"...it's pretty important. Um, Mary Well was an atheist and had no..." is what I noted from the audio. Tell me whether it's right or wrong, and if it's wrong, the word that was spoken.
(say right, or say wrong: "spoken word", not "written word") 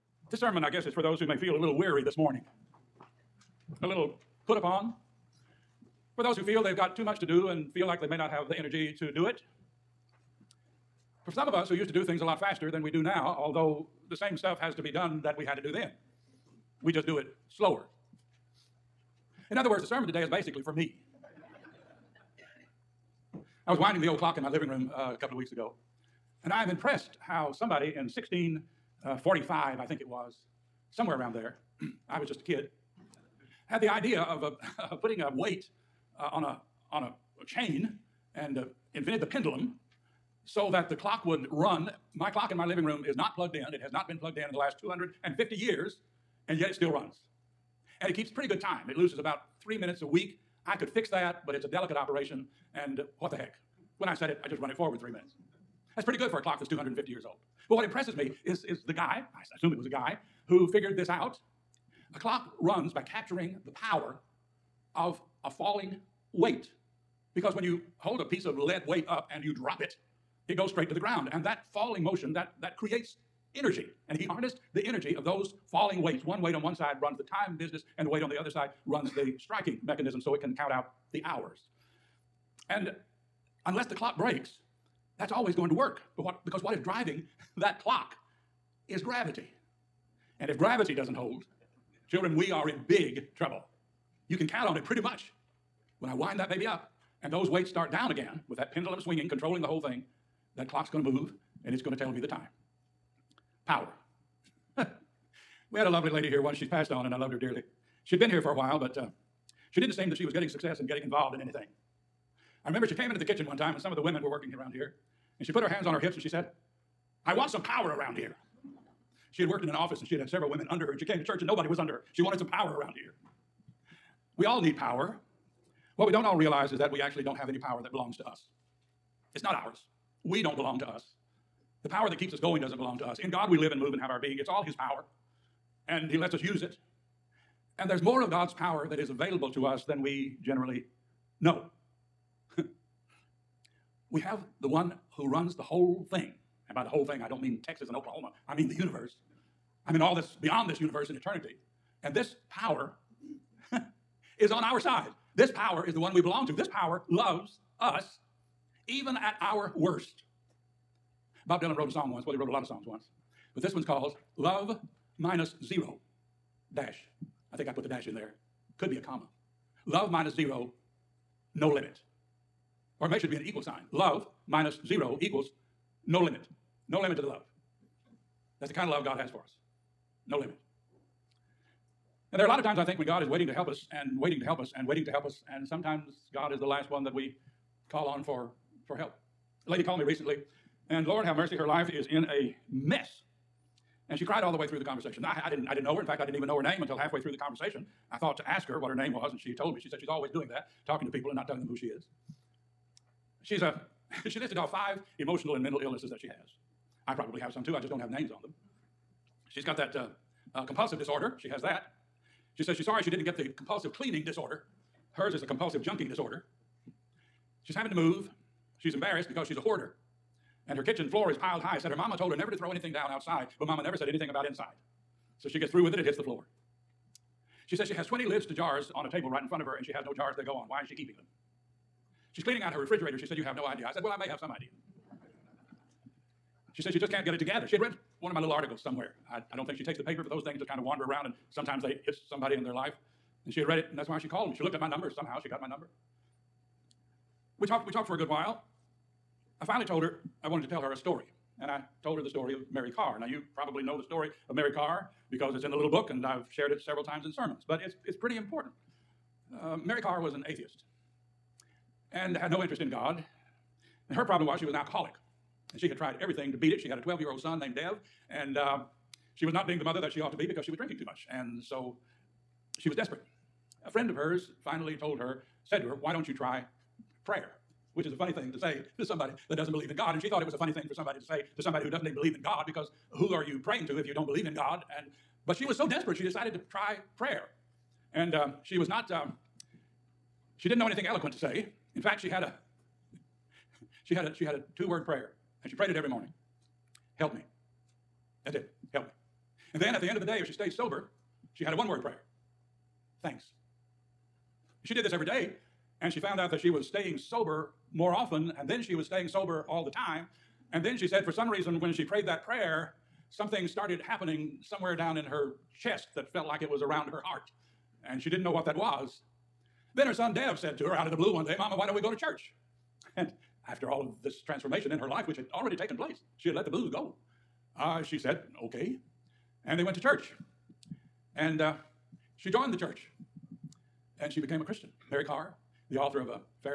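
wrong: "Karr", not "Well".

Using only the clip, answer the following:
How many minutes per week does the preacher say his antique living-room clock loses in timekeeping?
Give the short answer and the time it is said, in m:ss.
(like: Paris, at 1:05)
3, at 0:49.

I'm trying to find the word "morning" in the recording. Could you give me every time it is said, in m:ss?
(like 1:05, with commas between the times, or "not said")
0:02, 4:56.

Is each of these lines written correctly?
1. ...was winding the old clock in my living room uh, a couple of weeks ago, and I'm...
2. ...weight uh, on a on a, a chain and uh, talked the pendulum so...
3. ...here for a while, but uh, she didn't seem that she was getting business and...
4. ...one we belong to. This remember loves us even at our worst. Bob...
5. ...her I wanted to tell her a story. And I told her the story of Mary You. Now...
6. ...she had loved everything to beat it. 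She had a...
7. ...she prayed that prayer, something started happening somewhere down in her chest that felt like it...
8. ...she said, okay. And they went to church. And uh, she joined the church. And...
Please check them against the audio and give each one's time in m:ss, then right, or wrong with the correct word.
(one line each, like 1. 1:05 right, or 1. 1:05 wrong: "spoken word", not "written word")
1. 0:23 right
2. 0:35 wrong: "invented", not "talked"
3. 1:48 wrong: "success", not "business"
4. 2:35 wrong: "power", not "remember"
5. 4:10 wrong: "Karr", not "You"
6. 4:25 wrong: "tried", not "loved"
7. 5:11 right
8. 5:28 right.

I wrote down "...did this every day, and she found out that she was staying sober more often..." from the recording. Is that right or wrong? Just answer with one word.
right.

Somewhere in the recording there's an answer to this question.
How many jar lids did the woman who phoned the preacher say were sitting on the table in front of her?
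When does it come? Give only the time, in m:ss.
3:48.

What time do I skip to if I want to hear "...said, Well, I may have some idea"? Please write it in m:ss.
3:53.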